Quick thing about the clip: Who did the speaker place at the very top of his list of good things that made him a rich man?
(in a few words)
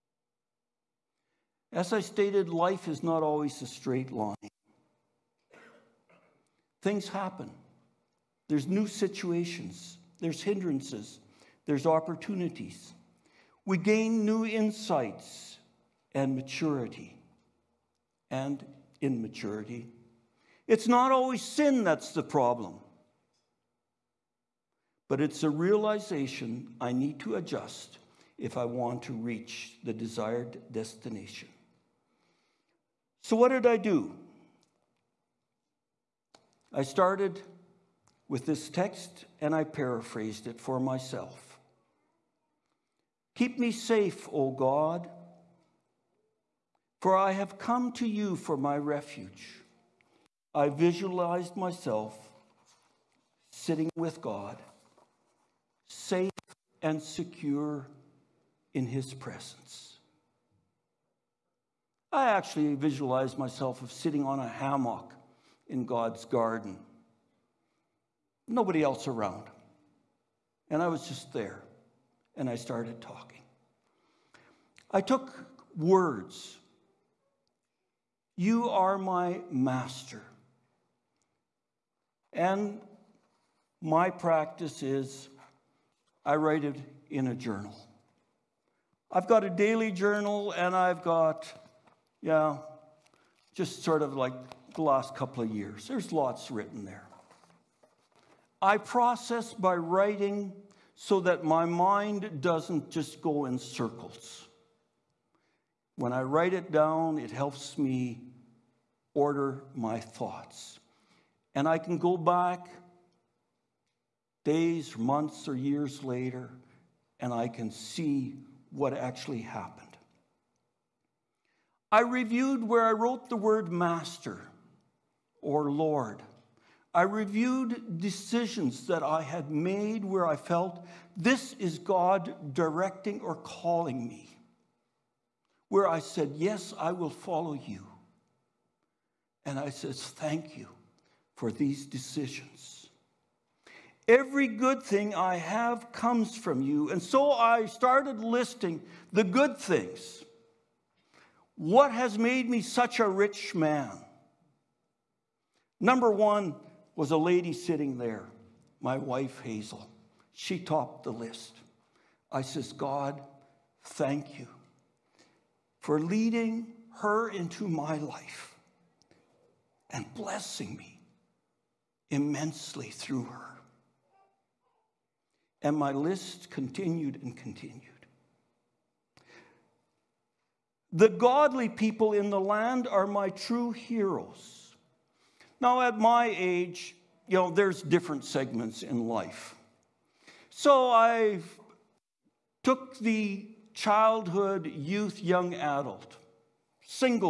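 Hazel.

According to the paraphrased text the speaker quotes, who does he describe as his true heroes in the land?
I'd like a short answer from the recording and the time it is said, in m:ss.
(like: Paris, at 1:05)
The godly people, at 3:00.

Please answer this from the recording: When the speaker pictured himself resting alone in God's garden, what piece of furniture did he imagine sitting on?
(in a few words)
hammock.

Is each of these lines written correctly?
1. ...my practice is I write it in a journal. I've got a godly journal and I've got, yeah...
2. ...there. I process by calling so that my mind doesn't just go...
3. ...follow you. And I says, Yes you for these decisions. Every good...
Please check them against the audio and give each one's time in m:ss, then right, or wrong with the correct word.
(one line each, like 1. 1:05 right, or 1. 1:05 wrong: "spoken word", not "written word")
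1. 1:23 wrong: "daily", not "godly"
2. 1:36 wrong: "writing", not "calling"
3. 2:17 wrong: "Thank", not "Yes".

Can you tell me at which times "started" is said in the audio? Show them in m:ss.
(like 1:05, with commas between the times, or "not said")
0:36, 1:12, 2:27.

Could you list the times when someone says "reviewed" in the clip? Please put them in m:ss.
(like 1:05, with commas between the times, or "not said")
2:01, 2:07.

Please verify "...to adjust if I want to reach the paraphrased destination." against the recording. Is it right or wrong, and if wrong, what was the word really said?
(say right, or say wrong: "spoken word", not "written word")
wrong: "desired", not "paraphrased".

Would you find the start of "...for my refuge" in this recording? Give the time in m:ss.
0:48.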